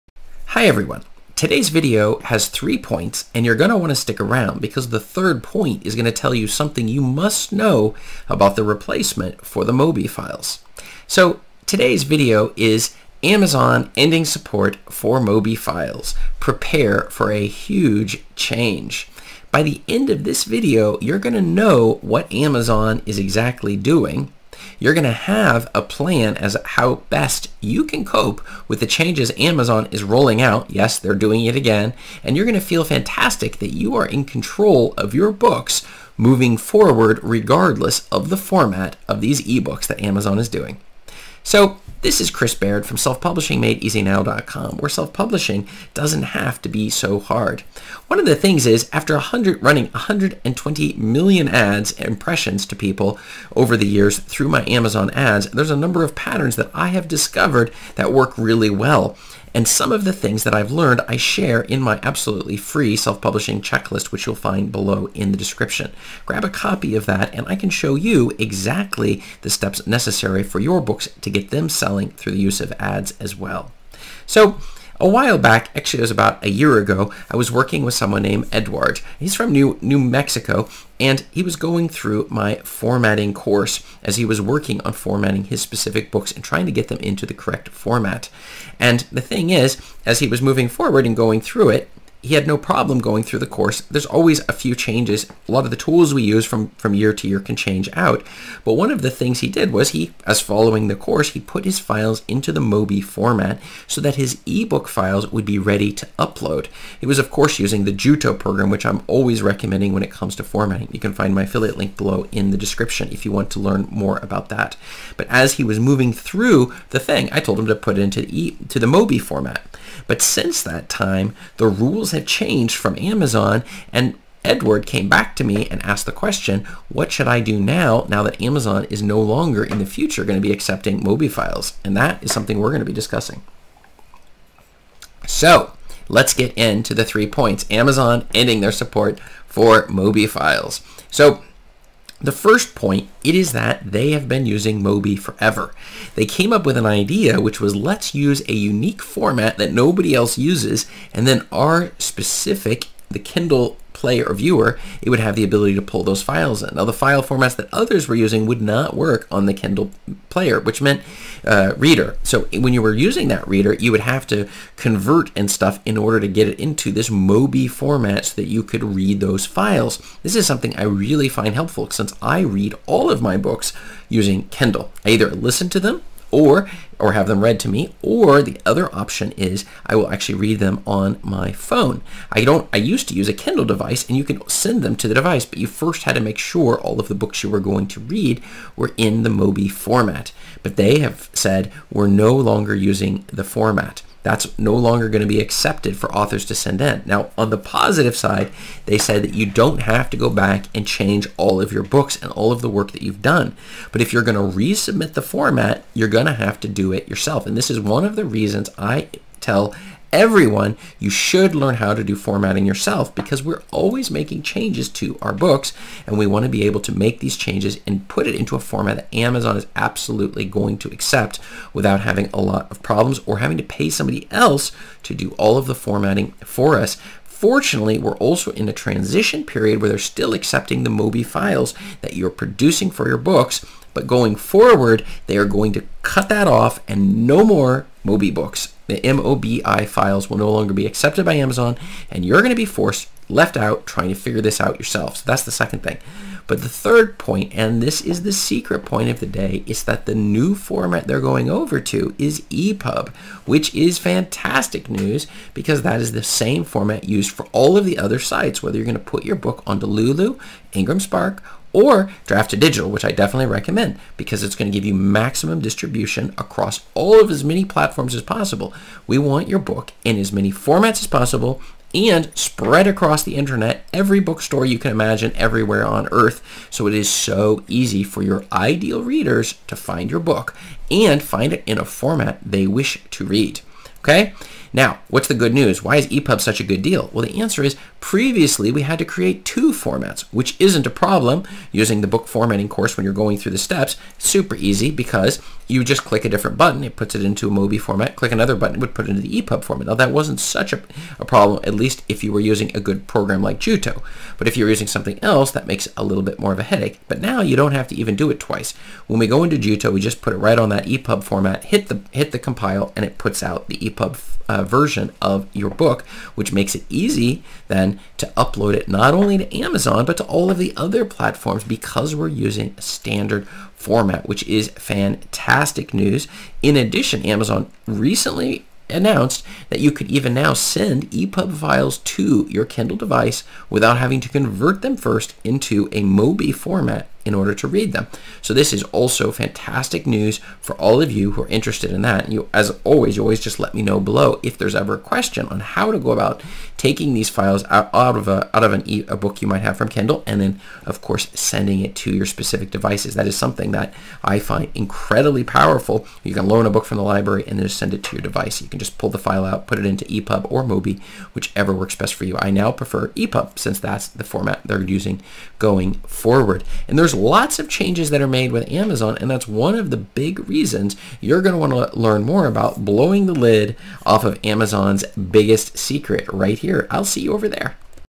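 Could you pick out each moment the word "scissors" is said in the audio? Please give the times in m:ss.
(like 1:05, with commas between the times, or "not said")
not said.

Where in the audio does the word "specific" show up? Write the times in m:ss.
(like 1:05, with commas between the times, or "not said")
1:25, 2:31, 5:52.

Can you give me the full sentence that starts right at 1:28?
And the thing is, as he was moving forward and going through it, he had no problem going through the course.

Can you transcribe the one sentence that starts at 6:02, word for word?
I now prefer EPUB since that's the format they're using going forward.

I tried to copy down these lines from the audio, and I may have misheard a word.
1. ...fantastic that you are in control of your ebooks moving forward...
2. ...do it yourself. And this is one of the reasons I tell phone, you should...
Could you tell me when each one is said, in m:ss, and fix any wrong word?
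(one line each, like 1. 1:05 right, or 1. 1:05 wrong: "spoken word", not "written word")
1. 0:32 wrong: "books", not "ebooks"
2. 3:26 wrong: "everyone", not "phone".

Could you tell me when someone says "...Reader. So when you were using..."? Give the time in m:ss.
2:41.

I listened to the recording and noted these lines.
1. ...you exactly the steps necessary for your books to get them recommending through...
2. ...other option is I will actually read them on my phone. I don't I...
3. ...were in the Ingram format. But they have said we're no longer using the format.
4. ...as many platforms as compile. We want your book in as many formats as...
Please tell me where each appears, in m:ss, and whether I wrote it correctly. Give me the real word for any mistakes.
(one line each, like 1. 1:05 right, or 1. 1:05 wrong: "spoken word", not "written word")
1. 1:07 wrong: "selling", not "recommending"
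2. 2:58 right
3. 3:08 wrong: "Mobi", not "Ingram"
4. 4:27 wrong: "possible", not "compile".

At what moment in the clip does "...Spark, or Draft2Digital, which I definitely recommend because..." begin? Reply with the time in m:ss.
4:20.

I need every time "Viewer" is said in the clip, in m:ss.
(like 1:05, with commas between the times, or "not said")
2:34.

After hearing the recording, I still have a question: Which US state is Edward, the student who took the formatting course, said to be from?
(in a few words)
New Mexico.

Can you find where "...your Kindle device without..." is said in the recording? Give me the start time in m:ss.
5:32.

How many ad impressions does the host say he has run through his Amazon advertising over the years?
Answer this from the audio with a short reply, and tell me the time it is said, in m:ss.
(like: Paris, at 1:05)
120 million, at 0:49.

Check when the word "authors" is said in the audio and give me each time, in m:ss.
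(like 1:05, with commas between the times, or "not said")
3:16.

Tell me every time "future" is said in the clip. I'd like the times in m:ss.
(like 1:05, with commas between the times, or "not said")
2:09.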